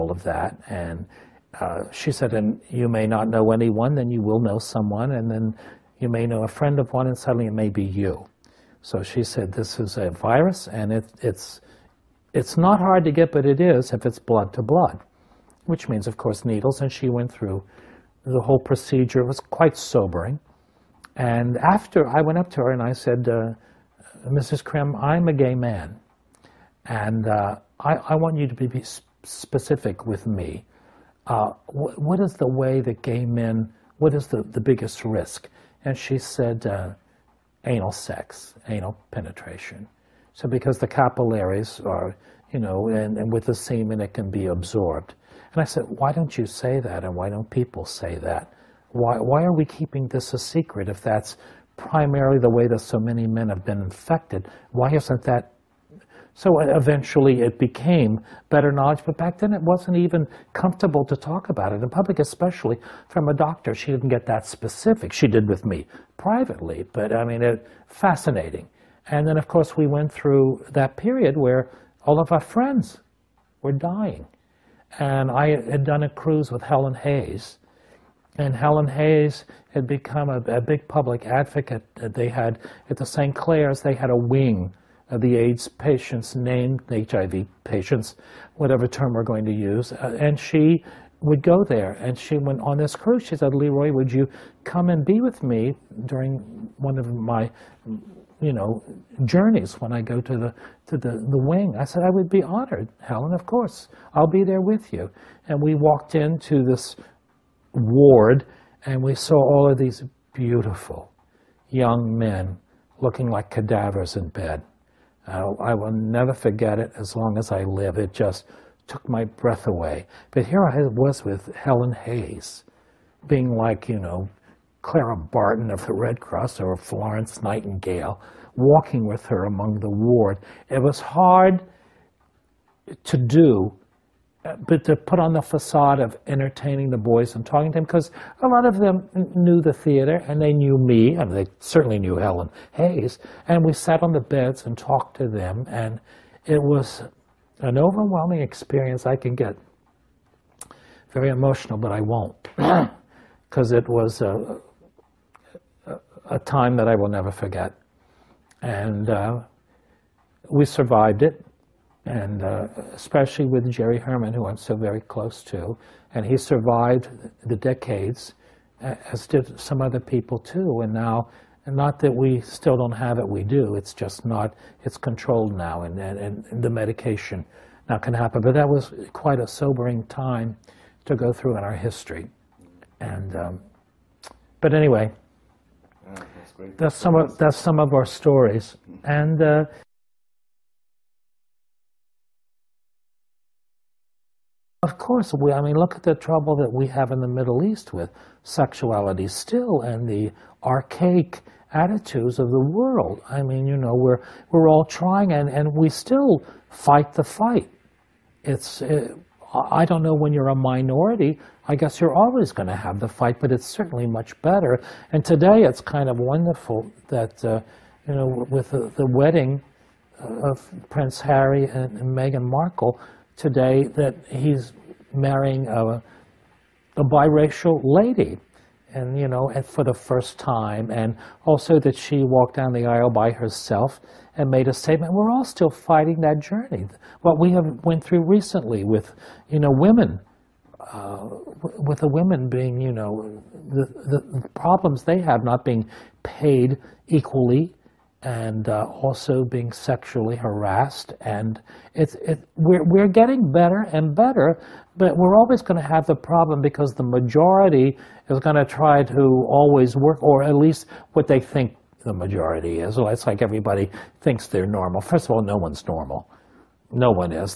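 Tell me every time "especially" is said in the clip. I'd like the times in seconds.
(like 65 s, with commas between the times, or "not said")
62 s, 162 s.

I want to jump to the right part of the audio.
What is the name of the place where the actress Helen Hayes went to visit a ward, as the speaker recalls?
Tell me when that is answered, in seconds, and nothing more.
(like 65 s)
83 s.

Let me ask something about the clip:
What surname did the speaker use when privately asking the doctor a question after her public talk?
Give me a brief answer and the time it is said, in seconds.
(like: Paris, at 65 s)
Krim, at 24 s.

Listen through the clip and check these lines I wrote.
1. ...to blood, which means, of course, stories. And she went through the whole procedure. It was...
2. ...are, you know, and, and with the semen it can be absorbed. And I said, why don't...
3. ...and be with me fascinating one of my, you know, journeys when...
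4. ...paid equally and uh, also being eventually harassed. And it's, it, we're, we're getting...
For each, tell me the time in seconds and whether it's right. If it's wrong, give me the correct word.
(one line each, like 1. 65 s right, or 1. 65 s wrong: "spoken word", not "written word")
1. 14 s wrong: "needles", not "stories"
2. 41 s right
3. 94 s wrong: "during", not "fascinating"
4. 246 s wrong: "sexually", not "eventually".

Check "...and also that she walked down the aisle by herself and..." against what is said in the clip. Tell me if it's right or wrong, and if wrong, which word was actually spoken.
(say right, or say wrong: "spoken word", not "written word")
right.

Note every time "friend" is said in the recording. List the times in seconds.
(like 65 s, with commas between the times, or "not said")
6 s, 72 s.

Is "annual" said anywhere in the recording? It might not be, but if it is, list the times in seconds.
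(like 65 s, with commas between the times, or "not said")
not said.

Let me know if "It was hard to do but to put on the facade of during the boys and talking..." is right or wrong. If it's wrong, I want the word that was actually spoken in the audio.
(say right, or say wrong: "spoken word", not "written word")
wrong: "entertaining", not "during".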